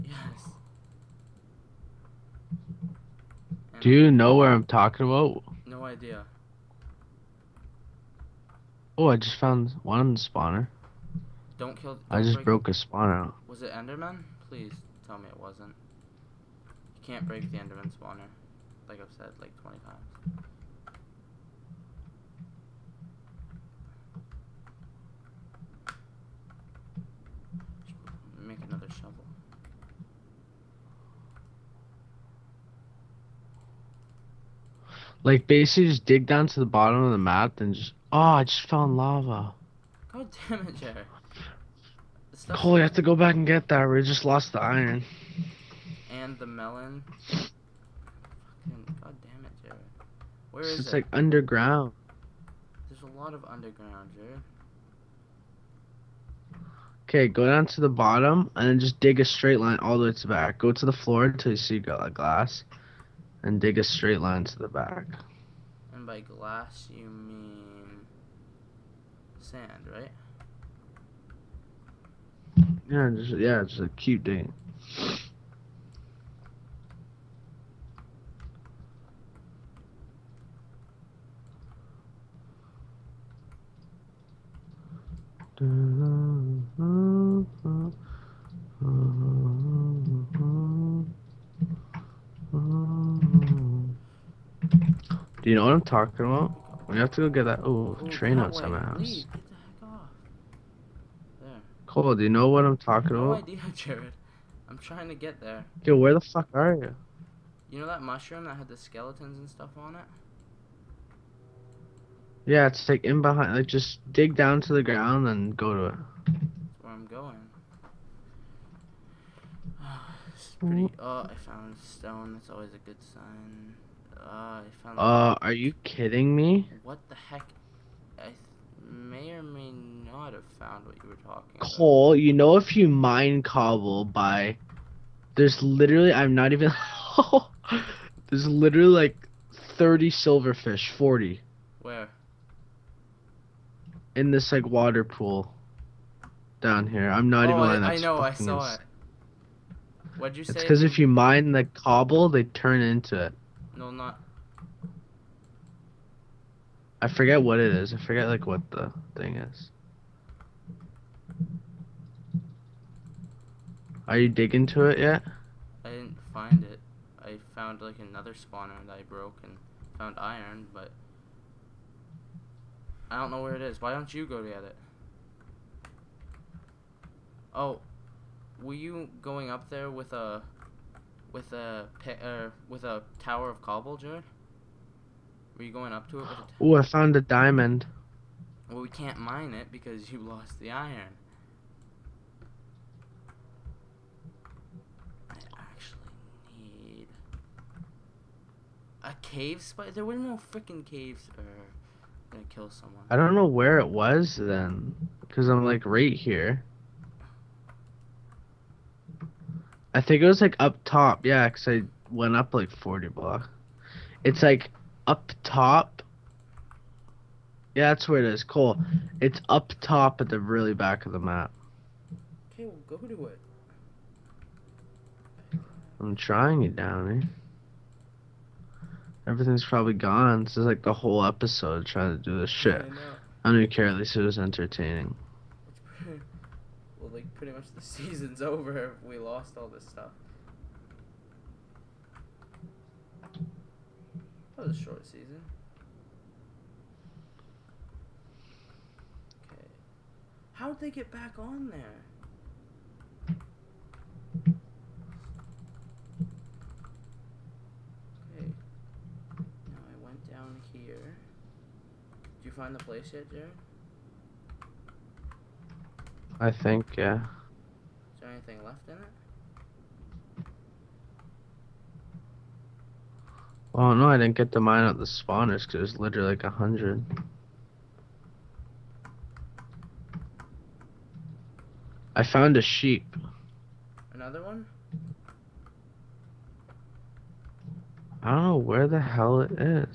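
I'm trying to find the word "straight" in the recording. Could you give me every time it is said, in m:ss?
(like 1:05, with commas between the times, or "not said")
0:59, 1:03.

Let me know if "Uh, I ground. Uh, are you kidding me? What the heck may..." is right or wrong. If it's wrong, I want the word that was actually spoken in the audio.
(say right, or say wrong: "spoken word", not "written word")
wrong: "found", not "ground".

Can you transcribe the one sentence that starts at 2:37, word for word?
I forget like what the thing is.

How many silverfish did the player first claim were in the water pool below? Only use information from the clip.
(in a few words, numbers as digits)
30.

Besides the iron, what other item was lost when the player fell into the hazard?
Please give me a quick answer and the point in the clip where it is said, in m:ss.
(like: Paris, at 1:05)
The melon, at 0:46.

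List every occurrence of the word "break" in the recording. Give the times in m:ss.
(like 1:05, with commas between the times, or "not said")
0:12, 0:17.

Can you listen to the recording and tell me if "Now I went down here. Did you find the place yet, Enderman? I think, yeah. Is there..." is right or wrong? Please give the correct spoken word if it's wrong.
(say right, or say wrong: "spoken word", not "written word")
wrong: "Jared", not "Enderman".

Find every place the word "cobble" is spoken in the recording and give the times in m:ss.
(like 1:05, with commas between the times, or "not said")
2:13, 2:31, 3:03.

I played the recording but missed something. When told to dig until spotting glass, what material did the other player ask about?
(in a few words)
Sand.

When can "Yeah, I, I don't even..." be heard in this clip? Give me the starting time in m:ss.
3:52.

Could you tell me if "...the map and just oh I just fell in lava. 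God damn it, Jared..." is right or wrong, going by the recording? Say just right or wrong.
right.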